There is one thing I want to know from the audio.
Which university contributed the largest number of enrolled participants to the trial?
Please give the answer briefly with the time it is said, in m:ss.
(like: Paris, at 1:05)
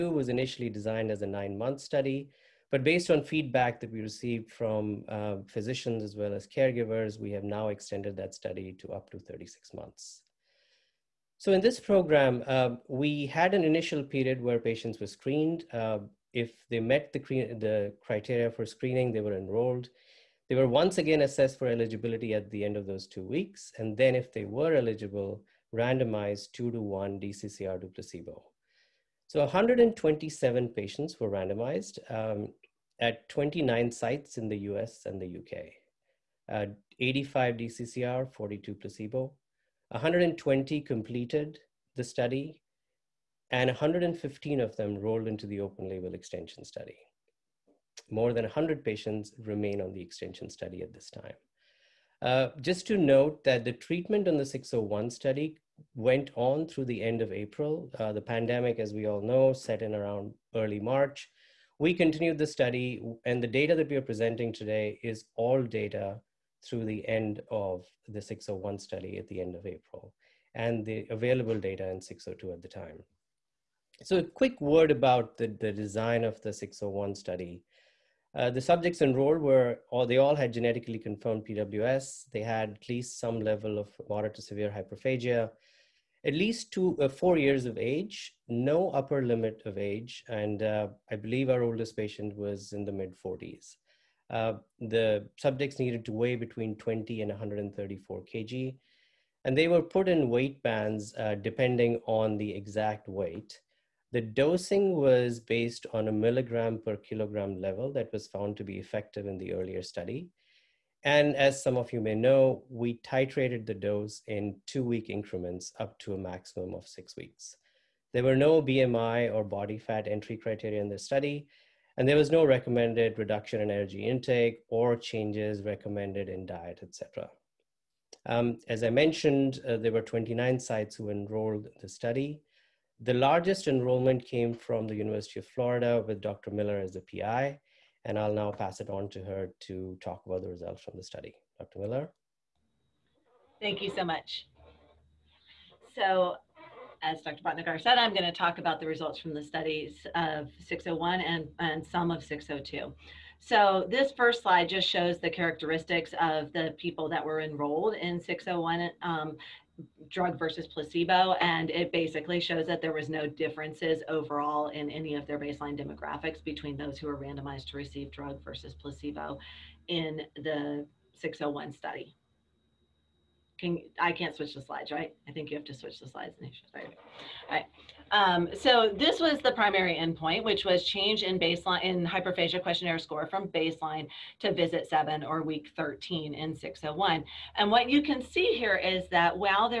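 University of Florida, at 2:14.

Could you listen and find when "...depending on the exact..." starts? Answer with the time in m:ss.
1:41.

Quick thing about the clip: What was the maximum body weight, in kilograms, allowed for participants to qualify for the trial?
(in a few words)
134 kg.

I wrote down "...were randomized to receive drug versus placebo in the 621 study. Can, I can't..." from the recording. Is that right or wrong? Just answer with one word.
wrong.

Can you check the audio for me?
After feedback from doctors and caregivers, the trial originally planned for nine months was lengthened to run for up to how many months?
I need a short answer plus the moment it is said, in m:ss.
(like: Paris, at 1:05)
36, at 0:09.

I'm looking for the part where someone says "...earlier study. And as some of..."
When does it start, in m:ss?
1:49.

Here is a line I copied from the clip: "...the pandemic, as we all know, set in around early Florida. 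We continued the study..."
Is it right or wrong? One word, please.
wrong.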